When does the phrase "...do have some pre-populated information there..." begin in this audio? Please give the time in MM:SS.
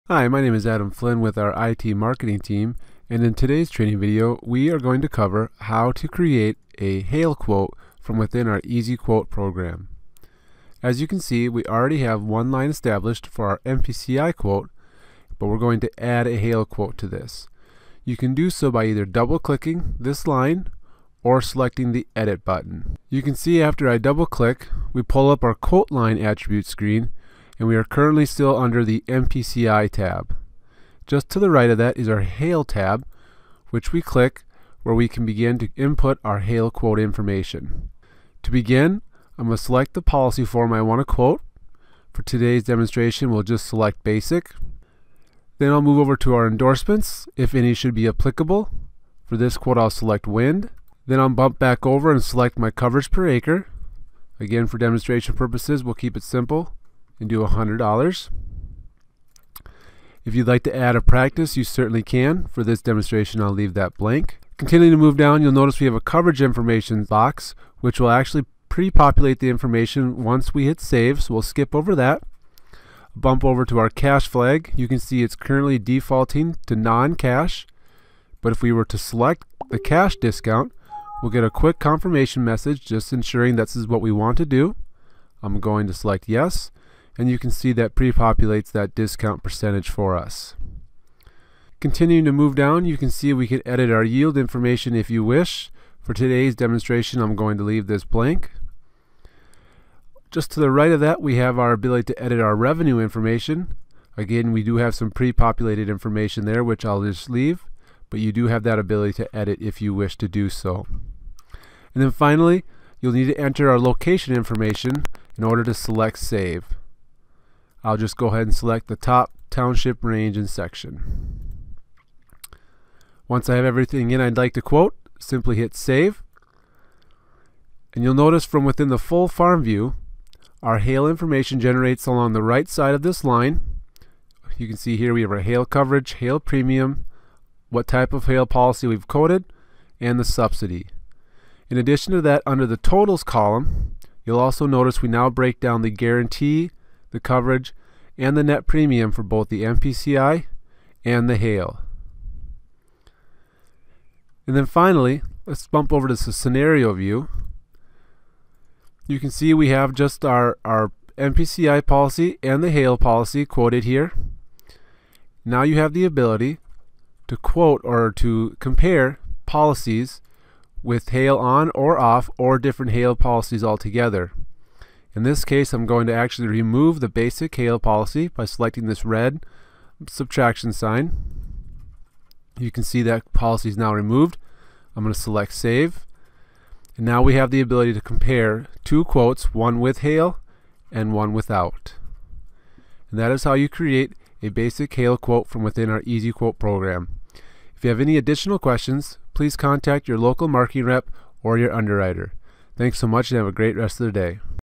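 01:44.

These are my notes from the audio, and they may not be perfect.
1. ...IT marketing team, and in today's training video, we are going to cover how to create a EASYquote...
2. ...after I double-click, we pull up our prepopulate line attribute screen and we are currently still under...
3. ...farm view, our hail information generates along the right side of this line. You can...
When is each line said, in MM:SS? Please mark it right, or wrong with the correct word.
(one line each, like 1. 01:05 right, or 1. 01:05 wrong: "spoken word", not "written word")
1. 00:01 wrong: "Hail", not "EASYquote"
2. 00:23 wrong: "quote", not "prepopulate"
3. 02:09 right.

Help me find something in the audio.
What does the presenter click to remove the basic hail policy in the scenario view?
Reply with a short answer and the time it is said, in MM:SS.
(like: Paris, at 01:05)
red subtraction sign, at 02:59.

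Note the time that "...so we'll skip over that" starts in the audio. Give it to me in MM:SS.
01:11.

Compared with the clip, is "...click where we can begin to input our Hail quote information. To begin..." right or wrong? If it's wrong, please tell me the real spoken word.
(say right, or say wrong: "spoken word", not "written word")
right.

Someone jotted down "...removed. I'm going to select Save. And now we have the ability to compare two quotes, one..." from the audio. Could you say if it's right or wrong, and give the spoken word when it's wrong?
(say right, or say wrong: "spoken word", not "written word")
right.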